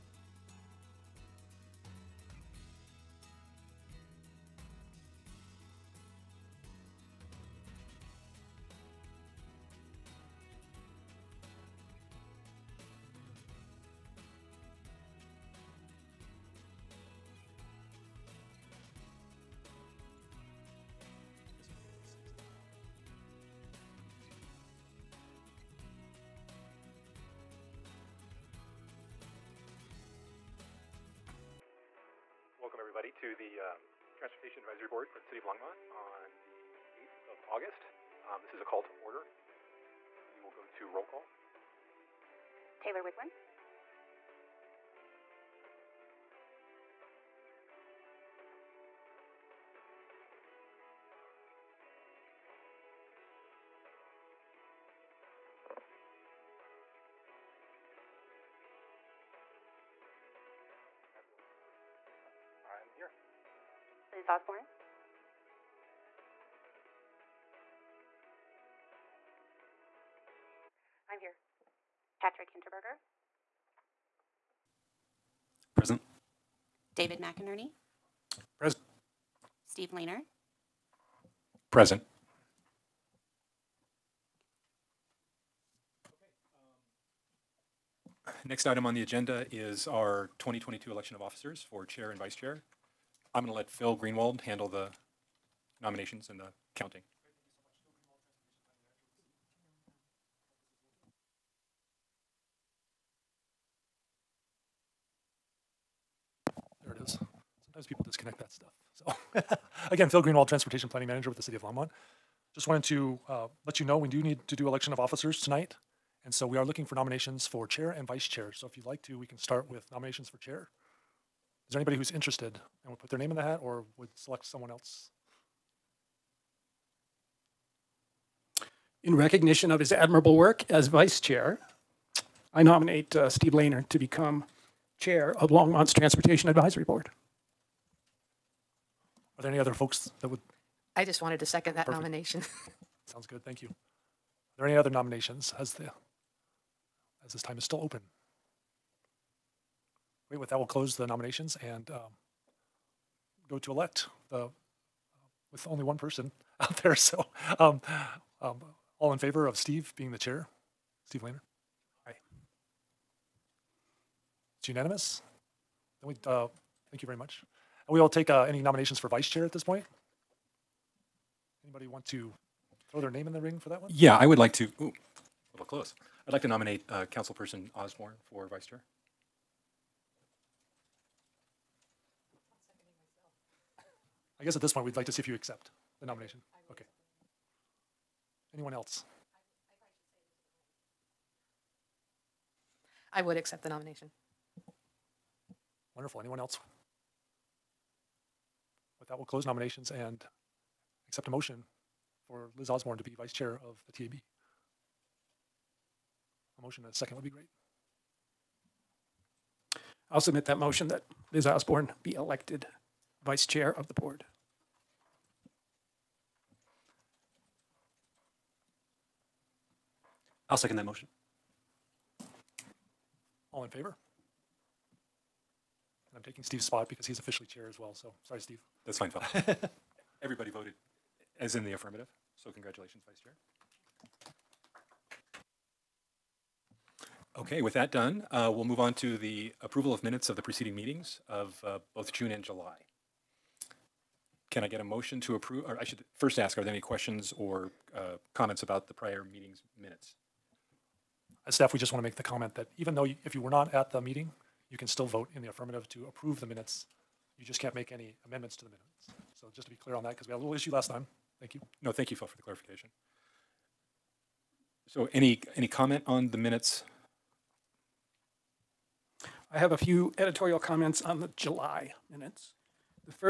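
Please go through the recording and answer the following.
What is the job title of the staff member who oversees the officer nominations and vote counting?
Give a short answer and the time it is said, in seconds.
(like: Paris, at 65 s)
Transportation Planning Manager, at 110 s.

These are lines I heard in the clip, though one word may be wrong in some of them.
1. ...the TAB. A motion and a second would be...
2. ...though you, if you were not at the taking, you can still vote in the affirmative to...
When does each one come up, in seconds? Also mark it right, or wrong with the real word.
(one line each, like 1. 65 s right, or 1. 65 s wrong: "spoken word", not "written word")
1. 203 s right
2. 252 s wrong: "meeting", not "taking".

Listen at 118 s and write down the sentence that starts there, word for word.
So if you'd like to, we can start with nominations for chair.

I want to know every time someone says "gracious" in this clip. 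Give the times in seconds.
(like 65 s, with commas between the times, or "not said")
not said.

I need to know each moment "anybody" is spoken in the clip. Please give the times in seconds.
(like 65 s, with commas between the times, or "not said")
121 s, 171 s.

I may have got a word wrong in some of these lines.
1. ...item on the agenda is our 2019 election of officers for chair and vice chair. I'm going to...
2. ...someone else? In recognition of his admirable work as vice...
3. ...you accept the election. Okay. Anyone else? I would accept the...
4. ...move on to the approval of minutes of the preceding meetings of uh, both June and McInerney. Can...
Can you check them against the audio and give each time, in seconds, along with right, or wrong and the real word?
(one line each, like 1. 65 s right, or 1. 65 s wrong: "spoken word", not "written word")
1. 88 s wrong: "2022", not "2019"
2. 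124 s right
3. 185 s wrong: "nomination", not "election"
4. 238 s wrong: "July", not "McInerney".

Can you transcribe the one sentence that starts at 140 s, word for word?
I just wanted to second that Perfect.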